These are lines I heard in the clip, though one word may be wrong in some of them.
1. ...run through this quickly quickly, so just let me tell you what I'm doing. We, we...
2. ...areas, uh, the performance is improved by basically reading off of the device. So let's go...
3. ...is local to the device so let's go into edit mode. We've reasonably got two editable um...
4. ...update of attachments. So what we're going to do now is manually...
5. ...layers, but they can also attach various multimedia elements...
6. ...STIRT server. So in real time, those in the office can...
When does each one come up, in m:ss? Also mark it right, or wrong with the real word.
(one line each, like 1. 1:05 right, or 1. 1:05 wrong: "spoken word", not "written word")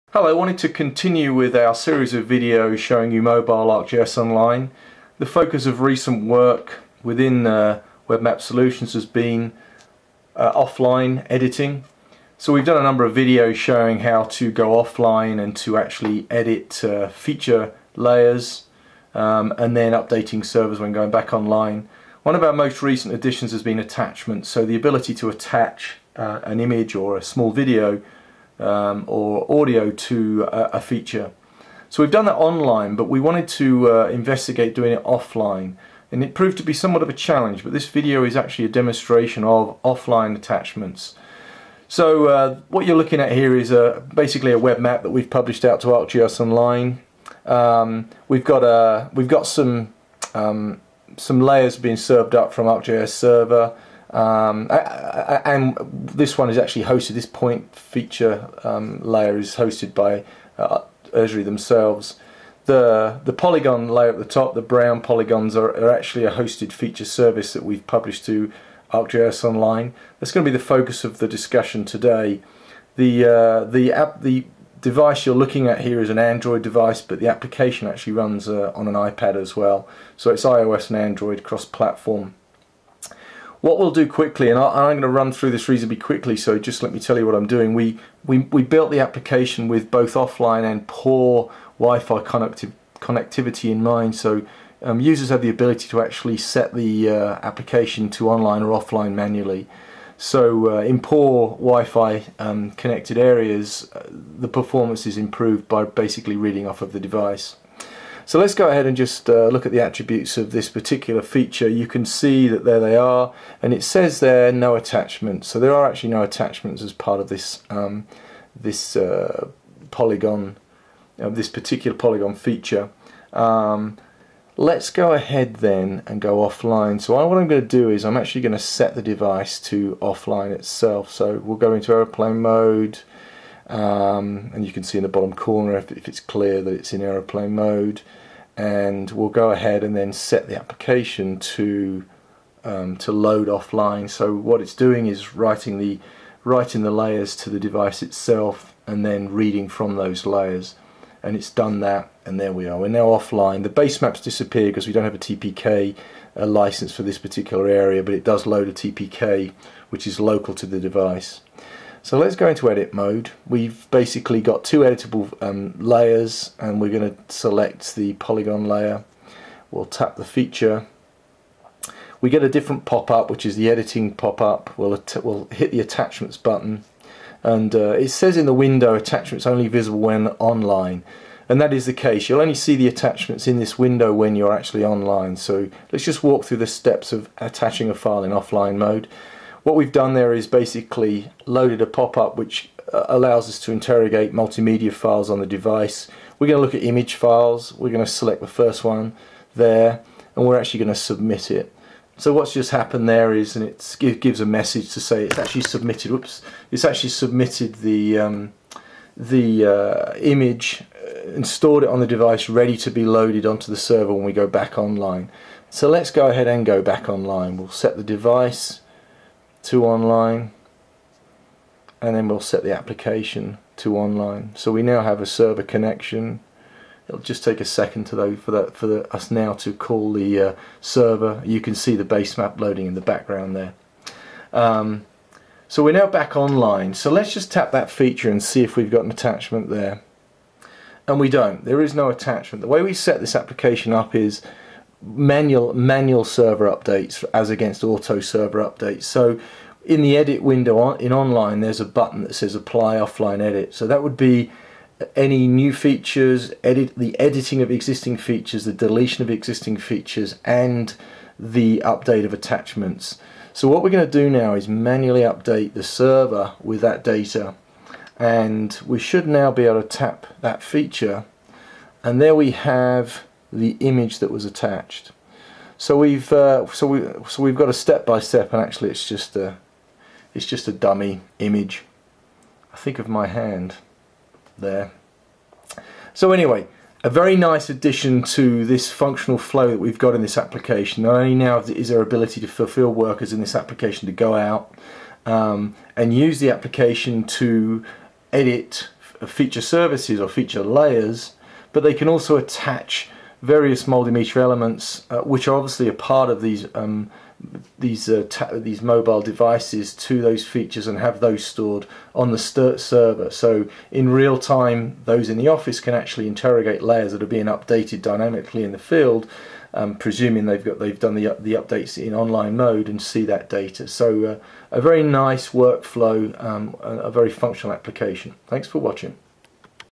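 1. 1:25 wrong: "reasonably", not "quickly"
2. 1:43 right
3. 2:40 wrong: "basically", not "reasonably"
4. 4:21 right
5. 5:00 right
6. 5:12 right.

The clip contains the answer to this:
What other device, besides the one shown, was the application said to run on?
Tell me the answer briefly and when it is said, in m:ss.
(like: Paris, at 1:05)
iPad, at 1:18.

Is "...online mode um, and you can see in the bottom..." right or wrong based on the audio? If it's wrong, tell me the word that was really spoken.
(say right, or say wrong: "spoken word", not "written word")
wrong: "airplane", not "online".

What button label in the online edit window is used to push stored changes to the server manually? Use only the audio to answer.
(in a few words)
Apply offline edit.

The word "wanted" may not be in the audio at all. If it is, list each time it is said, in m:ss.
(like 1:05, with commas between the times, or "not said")
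0:00, 0:33.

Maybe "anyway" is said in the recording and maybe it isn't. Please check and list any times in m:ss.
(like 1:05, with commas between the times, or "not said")
4:46.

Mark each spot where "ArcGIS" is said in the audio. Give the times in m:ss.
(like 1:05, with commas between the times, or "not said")
0:03, 0:45, 0:52, 1:08.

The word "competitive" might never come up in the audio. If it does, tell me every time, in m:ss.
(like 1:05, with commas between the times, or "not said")
not said.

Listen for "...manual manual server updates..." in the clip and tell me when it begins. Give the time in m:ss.
4:05.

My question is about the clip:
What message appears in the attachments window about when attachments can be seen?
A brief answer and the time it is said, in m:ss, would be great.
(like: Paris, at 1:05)
Attachments only visible when online, at 2:58.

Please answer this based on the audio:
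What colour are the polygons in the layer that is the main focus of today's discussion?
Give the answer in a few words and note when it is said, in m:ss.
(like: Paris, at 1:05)
Brown, at 1:04.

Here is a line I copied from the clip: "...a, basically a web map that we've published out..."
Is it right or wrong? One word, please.
right.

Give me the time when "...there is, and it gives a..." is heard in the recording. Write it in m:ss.
3:23.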